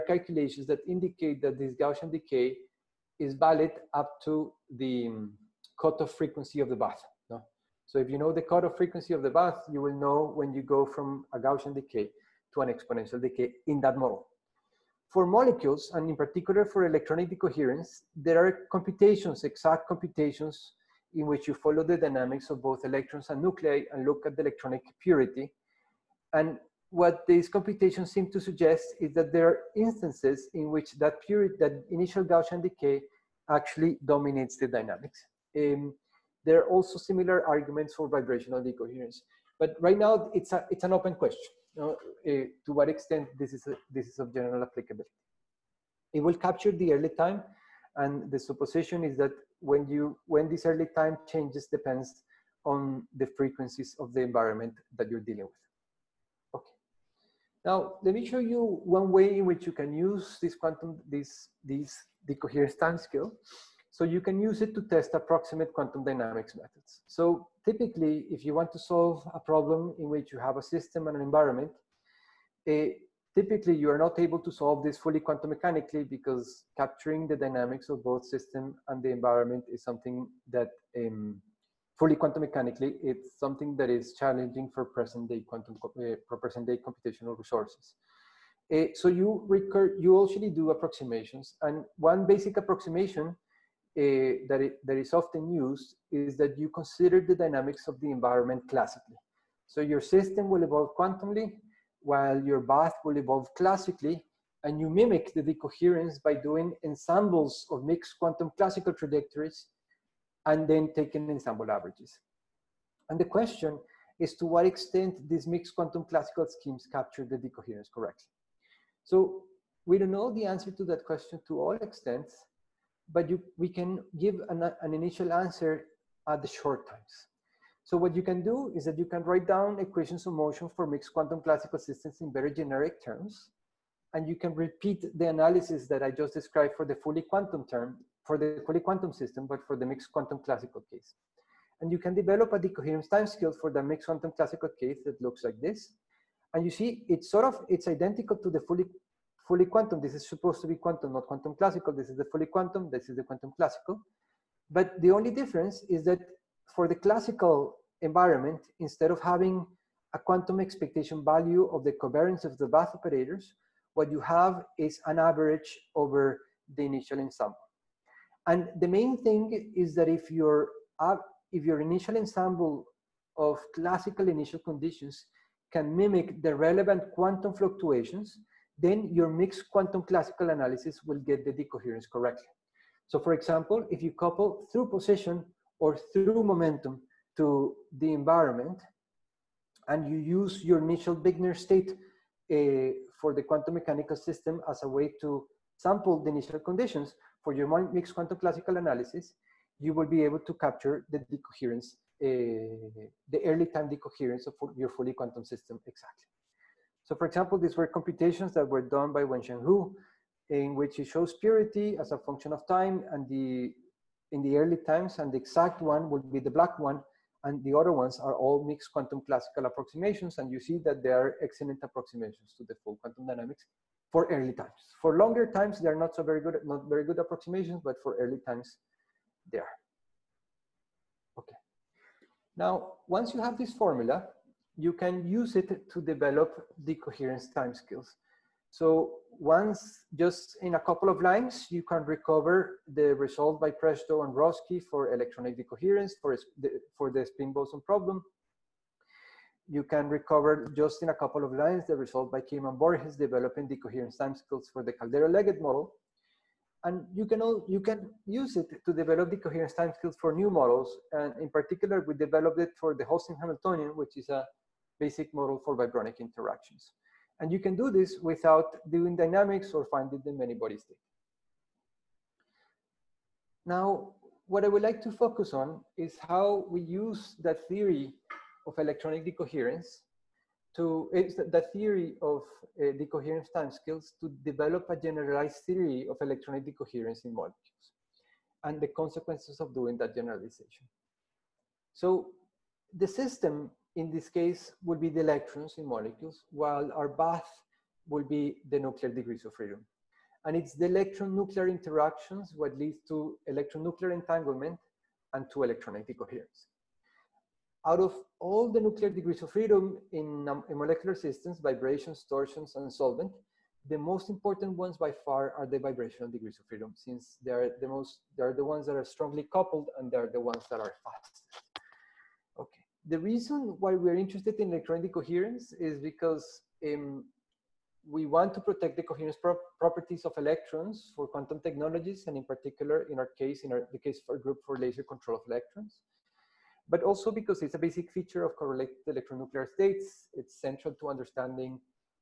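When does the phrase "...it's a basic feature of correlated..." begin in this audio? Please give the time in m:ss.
5:37.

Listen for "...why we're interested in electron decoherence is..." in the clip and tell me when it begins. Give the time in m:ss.
5:23.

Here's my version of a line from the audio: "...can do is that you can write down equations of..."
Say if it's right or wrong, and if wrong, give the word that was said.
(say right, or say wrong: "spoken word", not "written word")
right.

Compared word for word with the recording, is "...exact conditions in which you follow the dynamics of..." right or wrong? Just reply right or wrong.
wrong.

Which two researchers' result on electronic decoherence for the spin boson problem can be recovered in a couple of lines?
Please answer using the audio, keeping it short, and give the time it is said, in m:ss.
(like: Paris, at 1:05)
Prezhdo and Rossky, at 4:03.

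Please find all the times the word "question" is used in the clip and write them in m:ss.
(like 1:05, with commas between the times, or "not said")
0:41, 1:53, 2:01.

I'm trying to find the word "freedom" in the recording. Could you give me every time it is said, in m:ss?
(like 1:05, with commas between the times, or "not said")
4:59, 5:09, 5:16.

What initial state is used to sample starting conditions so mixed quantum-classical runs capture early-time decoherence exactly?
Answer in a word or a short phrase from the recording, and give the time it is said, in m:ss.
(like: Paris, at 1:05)
Wigner state, at 3:11.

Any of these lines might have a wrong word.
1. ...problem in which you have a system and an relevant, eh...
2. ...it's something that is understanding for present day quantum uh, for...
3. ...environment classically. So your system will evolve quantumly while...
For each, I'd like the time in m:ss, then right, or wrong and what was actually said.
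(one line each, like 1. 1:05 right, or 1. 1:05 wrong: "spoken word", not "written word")
1. 1:09 wrong: "environment", not "relevant"
2. 1:22 wrong: "challenging", not "understanding"
3. 1:38 right.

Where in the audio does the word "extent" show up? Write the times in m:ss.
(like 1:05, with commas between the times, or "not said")
0:42, 1:54, 2:01.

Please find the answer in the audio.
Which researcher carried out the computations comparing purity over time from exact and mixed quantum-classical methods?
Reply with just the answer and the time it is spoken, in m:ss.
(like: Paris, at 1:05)
Wenxiang Hu, at 3:29.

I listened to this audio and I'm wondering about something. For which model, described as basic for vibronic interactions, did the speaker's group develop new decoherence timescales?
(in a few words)
Holstein Hamiltonian.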